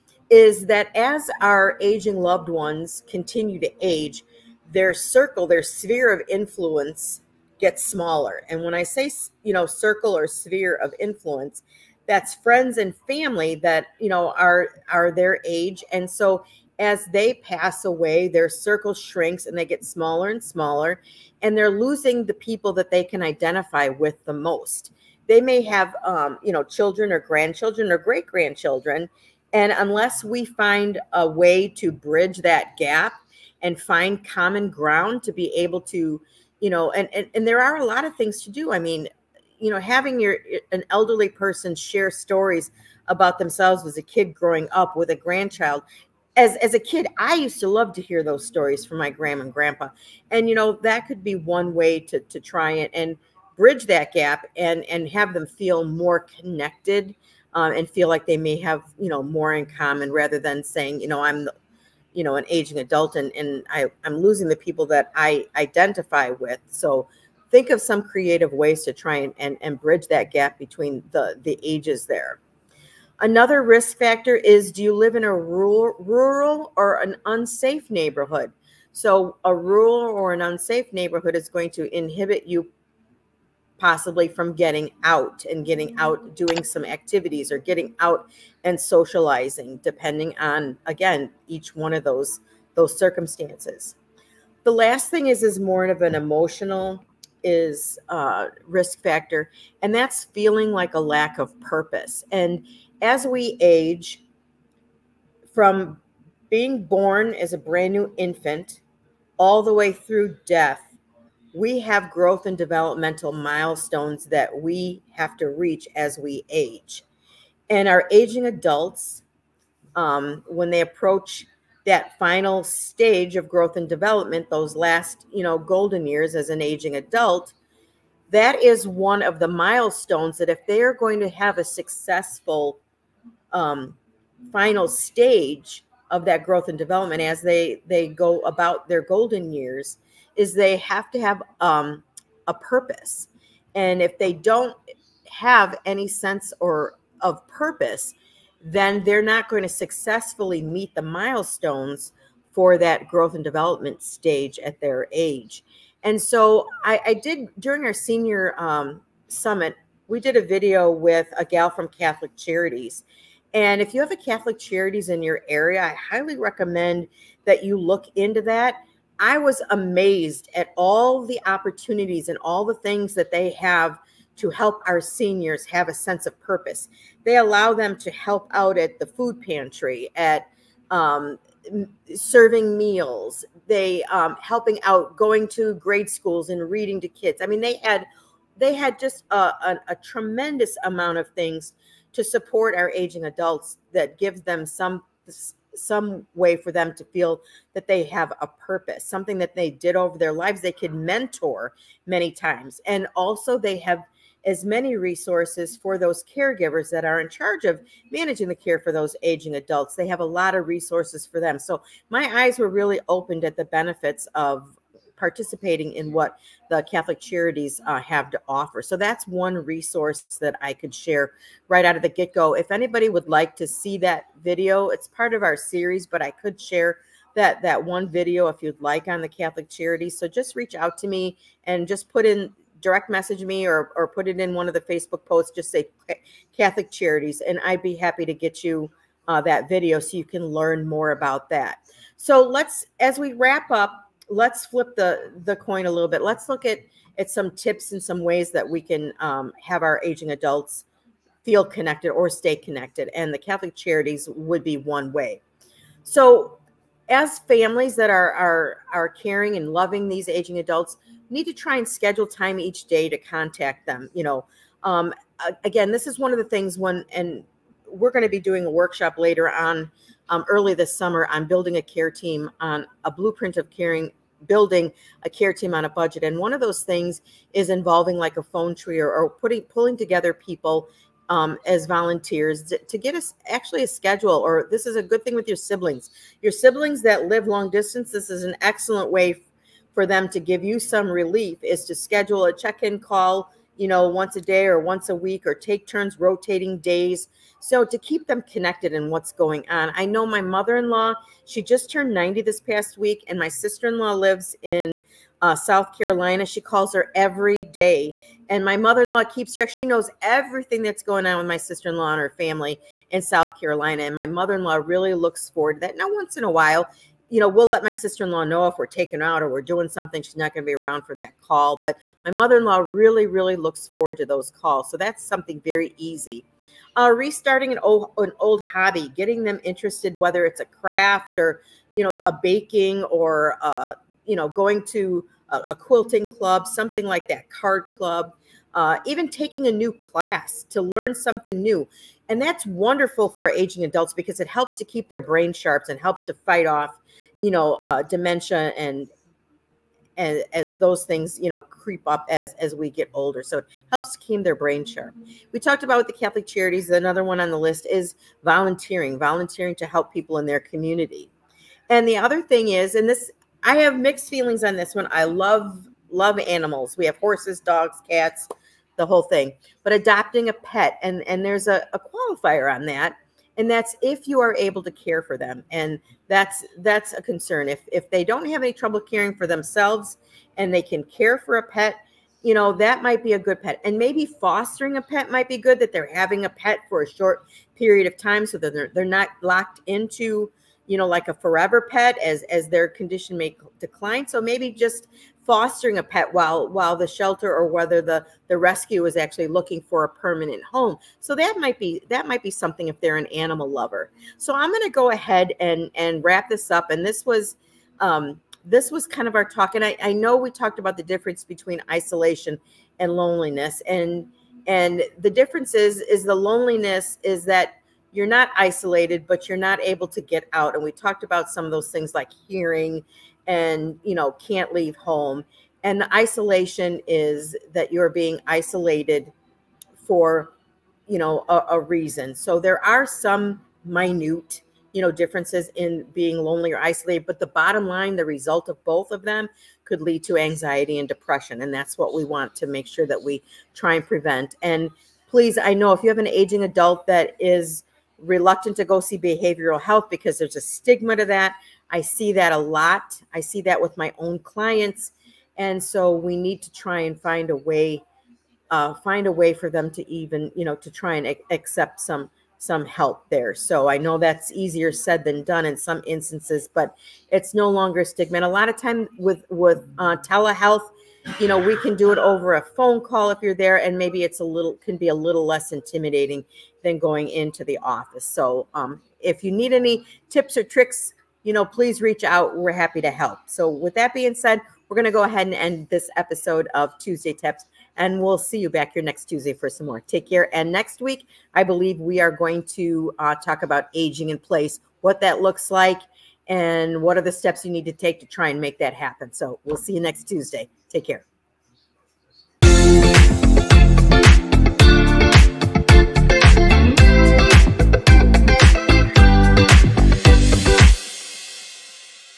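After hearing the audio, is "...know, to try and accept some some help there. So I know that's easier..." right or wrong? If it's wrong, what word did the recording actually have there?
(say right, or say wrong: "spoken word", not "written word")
right.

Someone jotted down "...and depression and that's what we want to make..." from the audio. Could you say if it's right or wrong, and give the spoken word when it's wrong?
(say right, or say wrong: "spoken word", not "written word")
right.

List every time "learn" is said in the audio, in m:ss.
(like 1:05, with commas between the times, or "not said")
4:00, 5:40.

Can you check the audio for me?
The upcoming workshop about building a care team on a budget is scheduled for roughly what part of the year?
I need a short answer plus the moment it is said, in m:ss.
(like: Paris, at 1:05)
early this summer, at 4:30.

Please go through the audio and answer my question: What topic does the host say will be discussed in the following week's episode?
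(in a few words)
aging in place.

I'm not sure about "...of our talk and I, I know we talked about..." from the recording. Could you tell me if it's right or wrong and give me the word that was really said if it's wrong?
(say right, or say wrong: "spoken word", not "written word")
right.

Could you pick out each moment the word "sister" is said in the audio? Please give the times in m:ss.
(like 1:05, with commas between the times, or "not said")
5:03, 5:11, 5:17.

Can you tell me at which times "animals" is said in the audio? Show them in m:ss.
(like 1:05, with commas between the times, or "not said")
6:06, 6:43.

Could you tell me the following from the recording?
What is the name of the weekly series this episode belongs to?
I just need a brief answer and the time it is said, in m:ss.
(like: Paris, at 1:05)
Tuesday Tips, at 8:06.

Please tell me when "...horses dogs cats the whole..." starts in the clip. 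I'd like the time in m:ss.
6:07.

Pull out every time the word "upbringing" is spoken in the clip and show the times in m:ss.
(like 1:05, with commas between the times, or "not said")
not said.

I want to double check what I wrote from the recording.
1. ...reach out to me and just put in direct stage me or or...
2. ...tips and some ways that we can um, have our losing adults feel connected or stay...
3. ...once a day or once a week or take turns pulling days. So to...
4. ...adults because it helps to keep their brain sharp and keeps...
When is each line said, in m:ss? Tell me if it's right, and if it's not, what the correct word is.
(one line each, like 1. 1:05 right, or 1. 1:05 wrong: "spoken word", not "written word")
1. 3:50 wrong: "message", not "stage"
2. 4:07 wrong: "aging", not "losing"
3. 4:54 wrong: "rotating", not "pulling"
4. 5:43 wrong: "helps", not "keeps".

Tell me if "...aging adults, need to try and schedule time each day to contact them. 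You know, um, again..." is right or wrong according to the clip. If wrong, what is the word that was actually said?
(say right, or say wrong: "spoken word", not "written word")
right.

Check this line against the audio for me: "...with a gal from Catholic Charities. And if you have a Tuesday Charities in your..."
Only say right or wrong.
wrong.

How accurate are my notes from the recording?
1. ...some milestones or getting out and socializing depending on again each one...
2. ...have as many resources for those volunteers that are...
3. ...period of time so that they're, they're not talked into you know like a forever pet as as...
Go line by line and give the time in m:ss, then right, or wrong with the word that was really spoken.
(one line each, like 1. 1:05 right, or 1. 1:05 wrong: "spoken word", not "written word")
1. 1:26 wrong: "activities", not "milestones"
2. 3:23 wrong: "caregivers", not "volunteers"
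3. 6:27 wrong: "locked", not "talked".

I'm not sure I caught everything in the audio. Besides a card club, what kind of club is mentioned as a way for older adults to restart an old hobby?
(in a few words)
quilting club.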